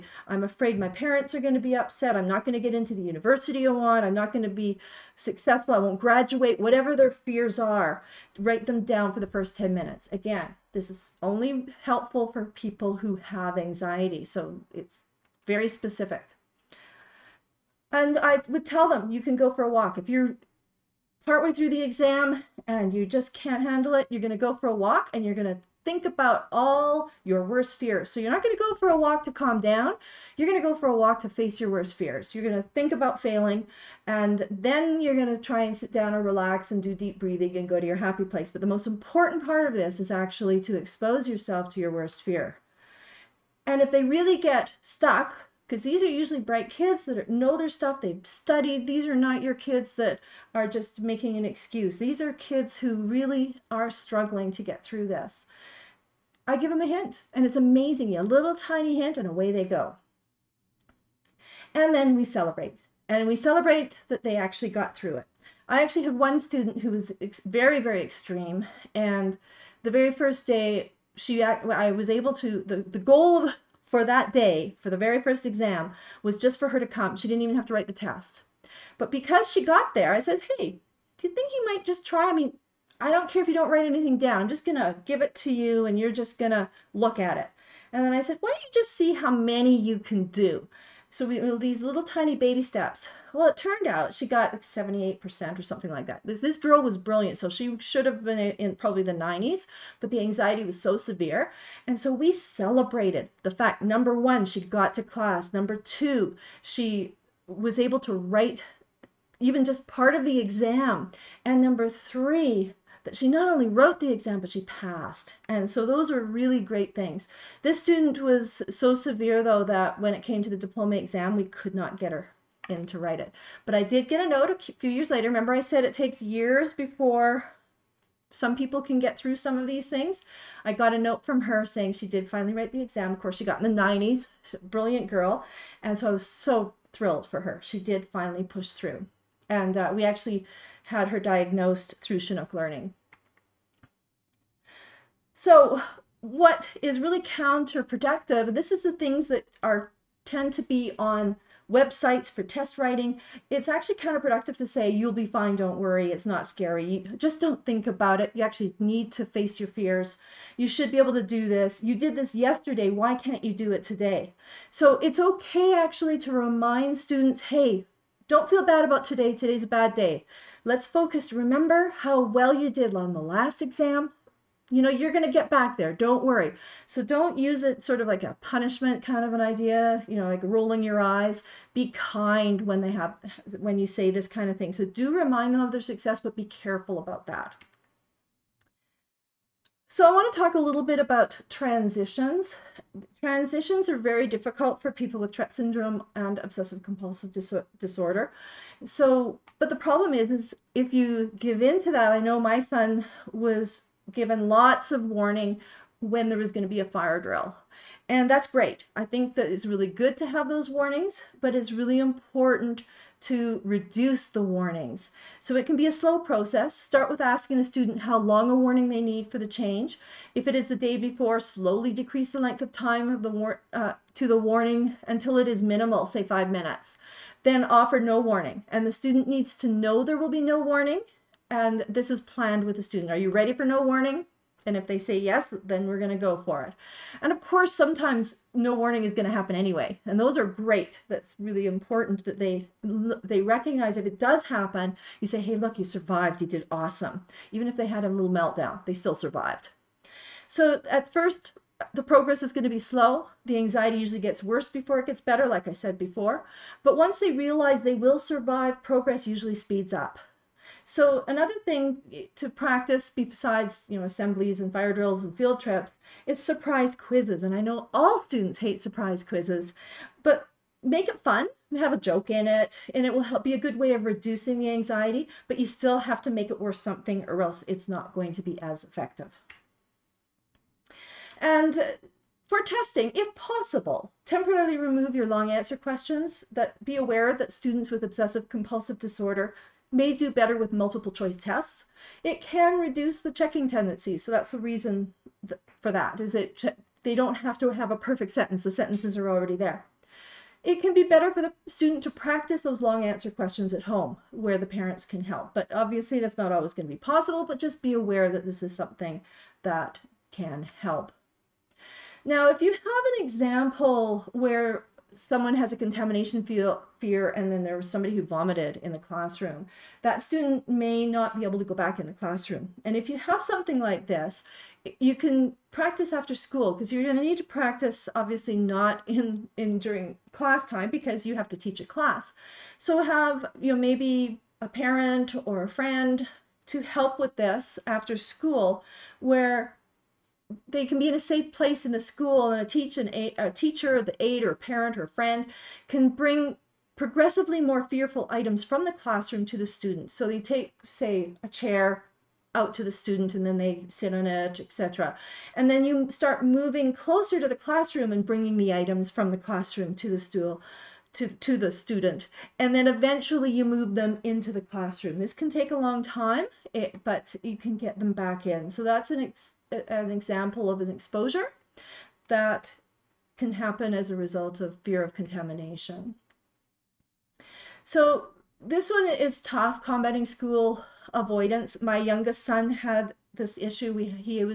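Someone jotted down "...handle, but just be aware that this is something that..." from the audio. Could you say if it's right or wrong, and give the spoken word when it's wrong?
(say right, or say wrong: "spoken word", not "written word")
wrong: "possible", not "handle".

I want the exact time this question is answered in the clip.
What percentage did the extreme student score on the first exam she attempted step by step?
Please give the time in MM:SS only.
01:34.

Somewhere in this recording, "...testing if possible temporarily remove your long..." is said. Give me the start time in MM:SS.
04:42.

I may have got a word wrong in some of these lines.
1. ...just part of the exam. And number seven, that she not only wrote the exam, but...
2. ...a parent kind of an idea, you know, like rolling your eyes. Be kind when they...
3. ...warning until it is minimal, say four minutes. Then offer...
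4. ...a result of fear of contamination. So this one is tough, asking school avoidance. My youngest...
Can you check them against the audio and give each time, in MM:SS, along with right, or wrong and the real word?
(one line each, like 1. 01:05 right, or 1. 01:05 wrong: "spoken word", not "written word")
1. 01:49 wrong: "three", not "seven"
2. 02:58 wrong: "punishment", not "parent"
3. 03:44 wrong: "five", not "four"
4. 06:14 wrong: "combating", not "asking".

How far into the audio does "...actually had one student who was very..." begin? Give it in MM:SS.
01:05.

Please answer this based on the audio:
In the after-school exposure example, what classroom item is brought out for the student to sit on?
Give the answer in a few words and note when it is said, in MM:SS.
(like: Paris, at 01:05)
a chair, at 05:51.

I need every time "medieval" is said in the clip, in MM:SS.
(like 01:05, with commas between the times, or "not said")
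not said.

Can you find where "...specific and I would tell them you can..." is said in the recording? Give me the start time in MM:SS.
00:15.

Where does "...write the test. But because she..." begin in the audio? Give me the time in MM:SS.
01:17.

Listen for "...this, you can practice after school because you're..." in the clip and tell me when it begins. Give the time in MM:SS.
05:24.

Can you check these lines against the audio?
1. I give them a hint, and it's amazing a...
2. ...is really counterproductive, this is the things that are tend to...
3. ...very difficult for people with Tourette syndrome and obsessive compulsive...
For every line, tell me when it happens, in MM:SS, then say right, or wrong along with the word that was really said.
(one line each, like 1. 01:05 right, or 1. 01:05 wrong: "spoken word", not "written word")
1. 00:56 right
2. 02:26 right
3. 03:13 right.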